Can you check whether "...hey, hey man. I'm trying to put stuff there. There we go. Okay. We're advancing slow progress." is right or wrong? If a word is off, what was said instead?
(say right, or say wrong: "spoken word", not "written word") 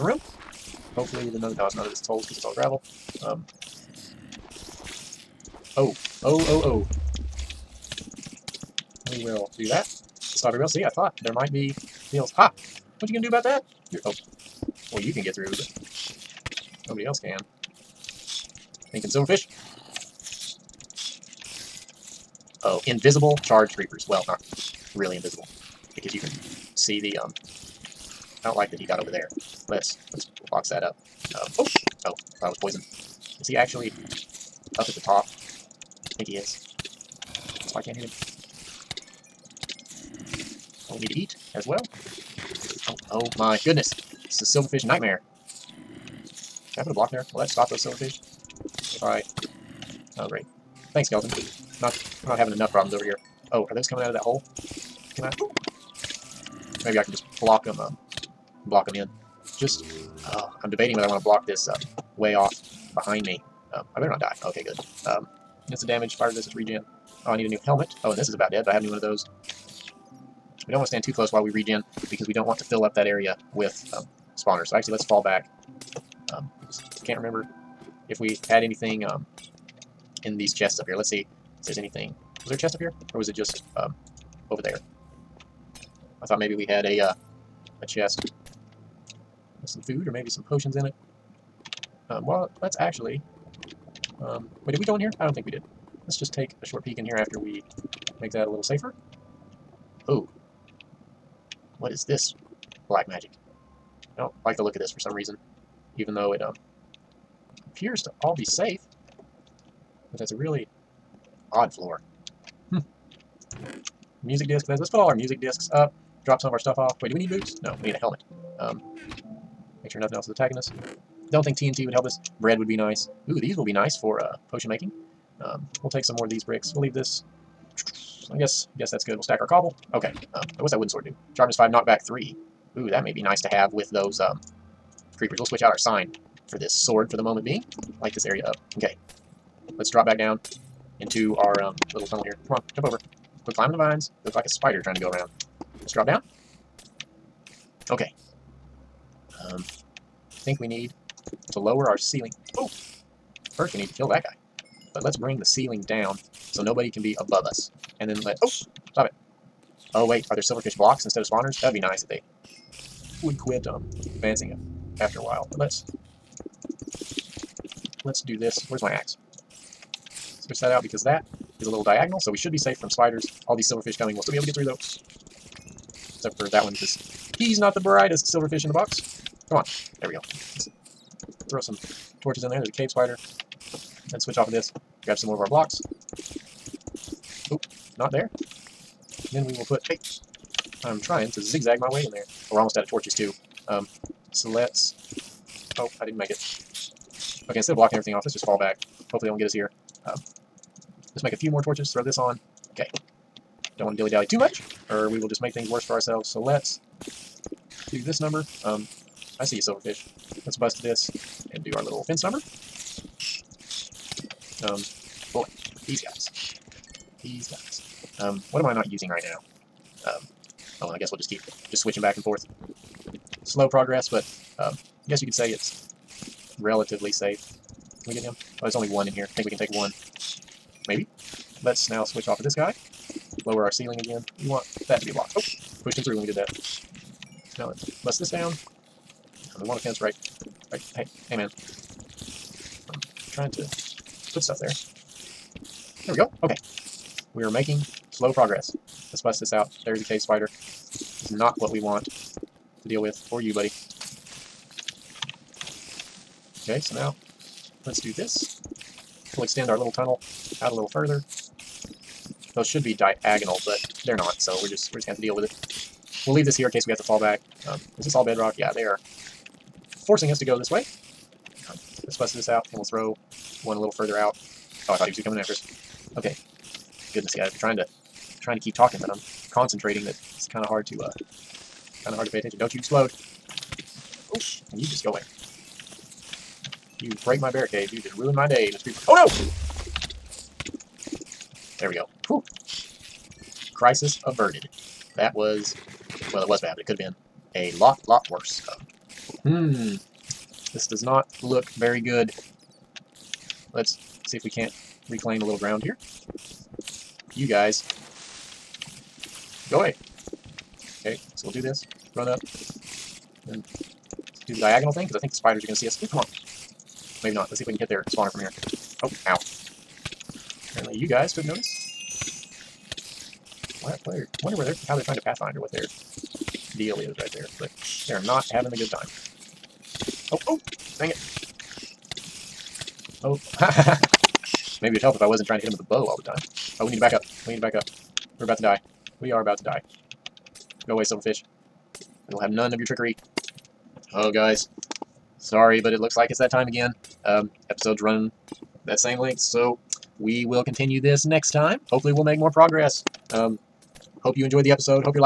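wrong: "making", not "advancing".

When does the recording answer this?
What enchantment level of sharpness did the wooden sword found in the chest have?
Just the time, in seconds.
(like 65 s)
131 s.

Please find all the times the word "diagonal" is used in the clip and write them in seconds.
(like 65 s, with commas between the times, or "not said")
171 s, 262 s, 314 s.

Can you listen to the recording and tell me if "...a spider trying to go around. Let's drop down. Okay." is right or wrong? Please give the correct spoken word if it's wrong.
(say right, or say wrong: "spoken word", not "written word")
right.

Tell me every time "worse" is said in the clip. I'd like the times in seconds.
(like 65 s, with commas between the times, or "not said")
205 s, 298 s.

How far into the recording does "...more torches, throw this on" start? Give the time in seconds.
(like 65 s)
201 s.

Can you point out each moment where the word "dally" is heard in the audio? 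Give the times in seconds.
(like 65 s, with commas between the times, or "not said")
203 s.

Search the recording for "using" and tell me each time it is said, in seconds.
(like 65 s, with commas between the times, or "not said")
218 s.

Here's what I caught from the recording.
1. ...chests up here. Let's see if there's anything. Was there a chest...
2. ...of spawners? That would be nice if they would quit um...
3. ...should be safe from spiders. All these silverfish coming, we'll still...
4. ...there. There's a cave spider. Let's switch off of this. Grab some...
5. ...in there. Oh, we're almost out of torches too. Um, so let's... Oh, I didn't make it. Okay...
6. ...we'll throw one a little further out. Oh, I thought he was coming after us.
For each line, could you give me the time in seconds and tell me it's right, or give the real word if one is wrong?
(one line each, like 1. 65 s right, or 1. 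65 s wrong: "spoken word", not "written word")
1. 80 s right
2. 161 s right
3. 172 s right
4. 182 s right
5. 192 s right
6. 272 s right.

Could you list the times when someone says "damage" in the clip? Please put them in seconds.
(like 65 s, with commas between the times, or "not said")
65 s.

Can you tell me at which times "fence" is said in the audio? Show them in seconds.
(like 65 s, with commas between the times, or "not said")
212 s, 239 s.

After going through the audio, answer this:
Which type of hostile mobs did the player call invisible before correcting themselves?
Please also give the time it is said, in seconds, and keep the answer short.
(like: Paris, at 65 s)
Charged creepers, at 23 s.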